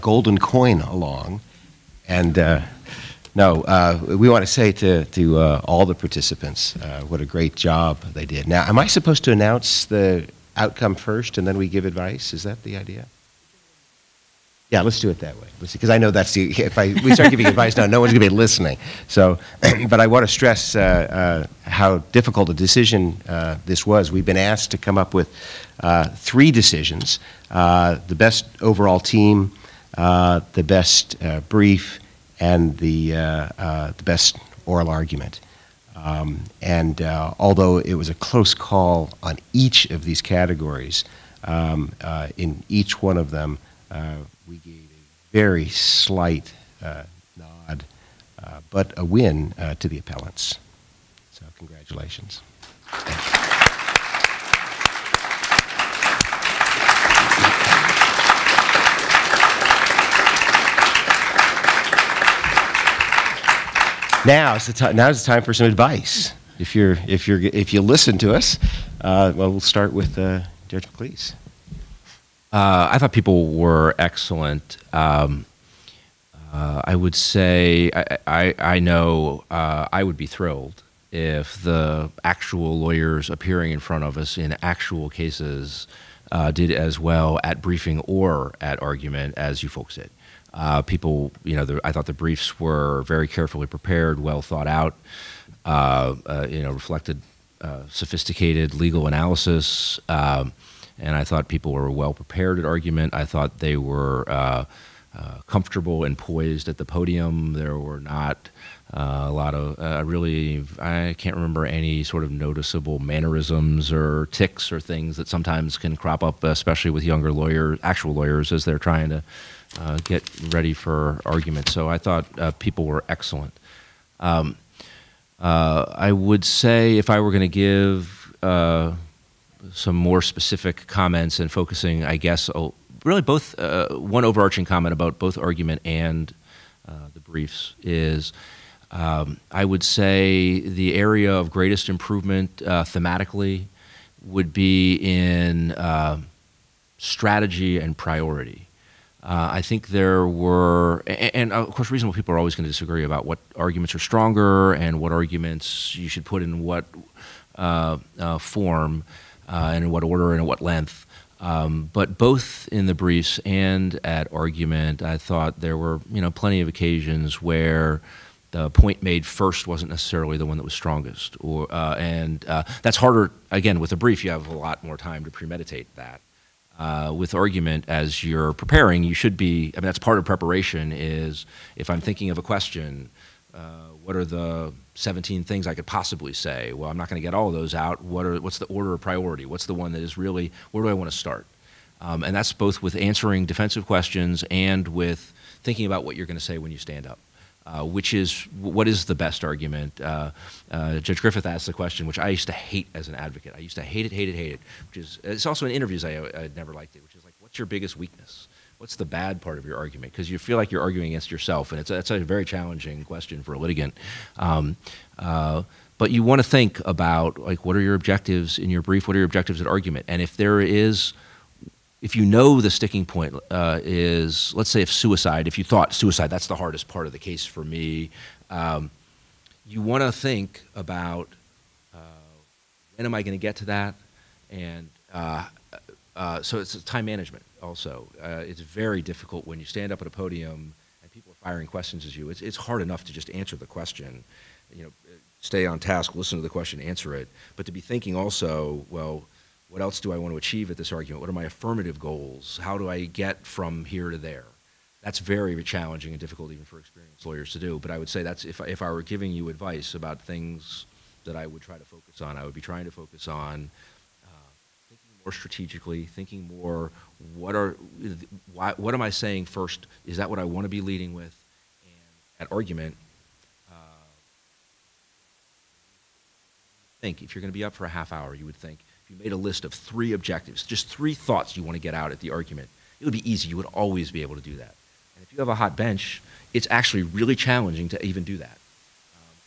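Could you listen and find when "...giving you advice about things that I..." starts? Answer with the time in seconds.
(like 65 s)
259 s.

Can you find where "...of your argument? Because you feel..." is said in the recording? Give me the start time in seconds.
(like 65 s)
209 s.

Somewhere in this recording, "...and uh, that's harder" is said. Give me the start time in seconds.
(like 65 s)
171 s.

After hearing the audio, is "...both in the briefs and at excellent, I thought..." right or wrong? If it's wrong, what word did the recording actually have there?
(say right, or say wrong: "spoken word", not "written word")
wrong: "argument", not "excellent".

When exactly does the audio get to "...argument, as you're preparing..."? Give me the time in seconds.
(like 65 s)
177 s.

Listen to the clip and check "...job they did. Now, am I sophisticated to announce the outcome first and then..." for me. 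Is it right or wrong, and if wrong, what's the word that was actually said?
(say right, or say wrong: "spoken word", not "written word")
wrong: "supposed", not "sophisticated".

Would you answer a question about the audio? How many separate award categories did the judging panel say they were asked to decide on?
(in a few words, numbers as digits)
3.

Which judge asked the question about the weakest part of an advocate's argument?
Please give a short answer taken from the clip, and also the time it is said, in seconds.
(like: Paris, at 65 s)
Judge Griffith, at 200 s.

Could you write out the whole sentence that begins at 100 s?
Um, and I thought people were well prepared at argument.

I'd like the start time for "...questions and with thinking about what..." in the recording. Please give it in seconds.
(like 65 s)
193 s.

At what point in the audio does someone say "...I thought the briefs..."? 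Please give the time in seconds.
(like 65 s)
91 s.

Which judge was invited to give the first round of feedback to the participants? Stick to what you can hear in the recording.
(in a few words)
Judge McLeese.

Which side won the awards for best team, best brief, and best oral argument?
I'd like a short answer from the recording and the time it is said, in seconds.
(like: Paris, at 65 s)
The appellants, at 49 s.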